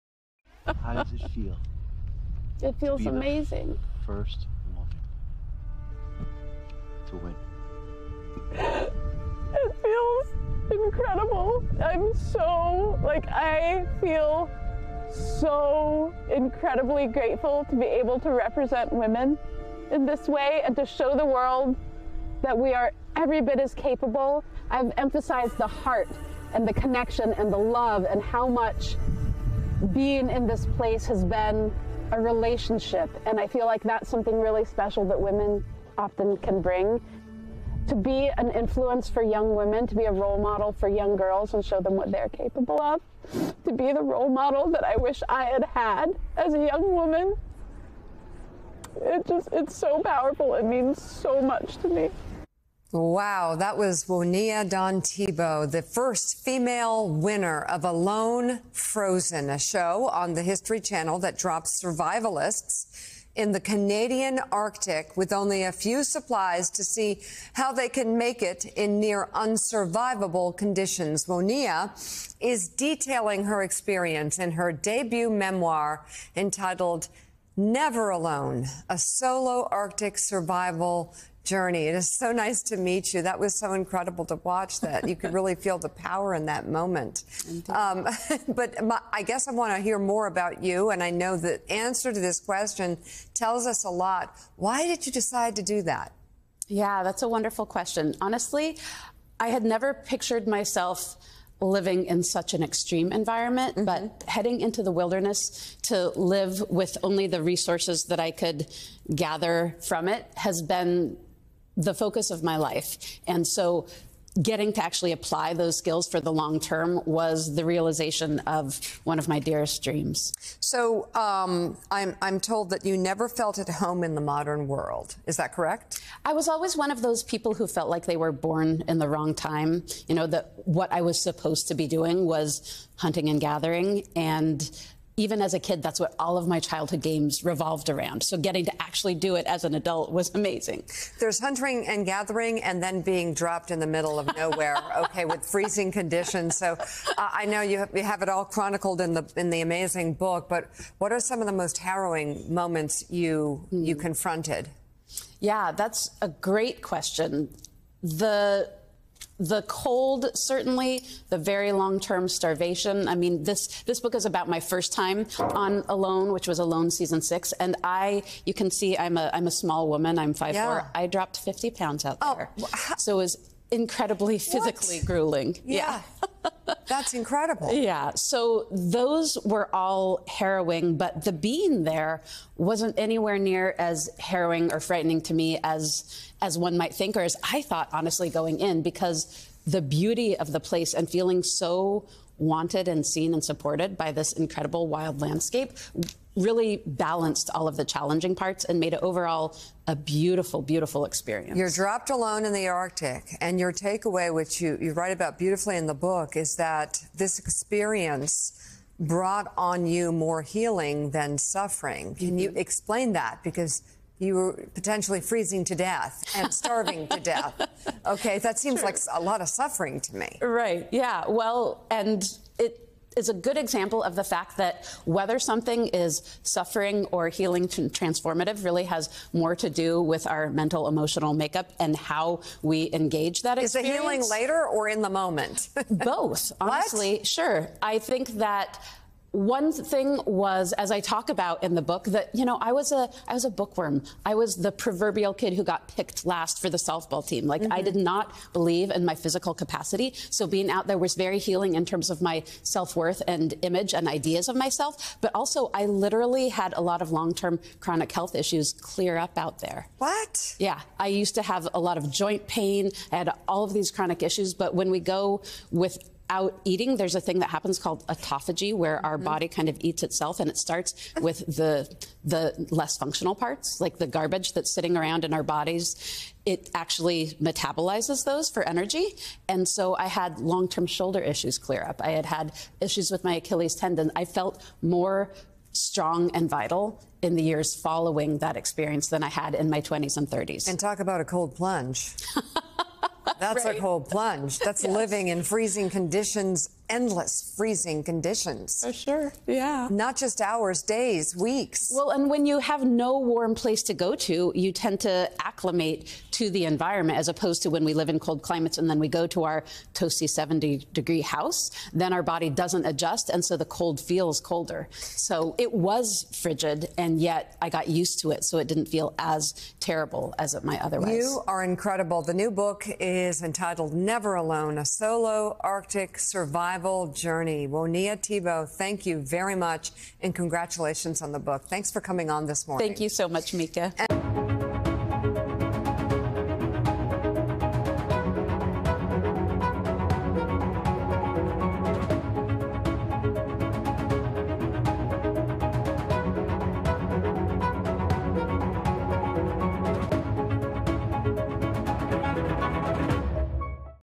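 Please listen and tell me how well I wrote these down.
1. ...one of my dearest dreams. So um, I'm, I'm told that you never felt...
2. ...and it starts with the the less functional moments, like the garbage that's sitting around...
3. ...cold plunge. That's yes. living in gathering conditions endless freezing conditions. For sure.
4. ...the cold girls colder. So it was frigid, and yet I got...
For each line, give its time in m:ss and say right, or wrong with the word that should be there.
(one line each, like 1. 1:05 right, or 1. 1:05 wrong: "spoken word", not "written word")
1. 1:59 right
2. 4:30 wrong: "parts", not "moments"
3. 4:53 wrong: "freezing", not "gathering"
4. 5:13 wrong: "feels", not "girls".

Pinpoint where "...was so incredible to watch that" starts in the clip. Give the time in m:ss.
1:23.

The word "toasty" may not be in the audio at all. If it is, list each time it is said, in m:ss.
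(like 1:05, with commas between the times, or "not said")
5:09.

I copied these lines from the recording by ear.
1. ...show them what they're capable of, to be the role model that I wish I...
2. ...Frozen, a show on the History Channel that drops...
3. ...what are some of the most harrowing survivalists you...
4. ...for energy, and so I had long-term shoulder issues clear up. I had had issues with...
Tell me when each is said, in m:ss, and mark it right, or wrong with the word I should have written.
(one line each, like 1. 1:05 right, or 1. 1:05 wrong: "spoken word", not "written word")
1. 0:41 right
2. 0:58 right
3. 2:30 wrong: "moments", not "survivalists"
4. 4:38 right.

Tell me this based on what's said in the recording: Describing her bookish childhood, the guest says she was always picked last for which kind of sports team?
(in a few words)
softball.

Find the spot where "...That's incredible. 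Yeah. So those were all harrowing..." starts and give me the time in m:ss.
2:56.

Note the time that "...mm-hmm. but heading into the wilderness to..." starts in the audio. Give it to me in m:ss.
1:43.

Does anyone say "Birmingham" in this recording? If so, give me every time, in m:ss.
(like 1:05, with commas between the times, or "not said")
not said.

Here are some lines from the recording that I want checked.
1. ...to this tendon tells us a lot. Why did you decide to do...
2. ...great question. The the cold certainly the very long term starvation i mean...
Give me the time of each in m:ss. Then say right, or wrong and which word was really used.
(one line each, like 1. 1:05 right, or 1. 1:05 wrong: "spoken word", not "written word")
1. 1:32 wrong: "question", not "tendon"
2. 2:36 right.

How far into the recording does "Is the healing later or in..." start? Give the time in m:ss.
3:54.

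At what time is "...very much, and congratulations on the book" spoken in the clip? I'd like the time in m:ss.
5:29.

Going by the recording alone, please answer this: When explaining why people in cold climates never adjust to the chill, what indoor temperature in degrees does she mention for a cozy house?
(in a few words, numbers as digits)
70.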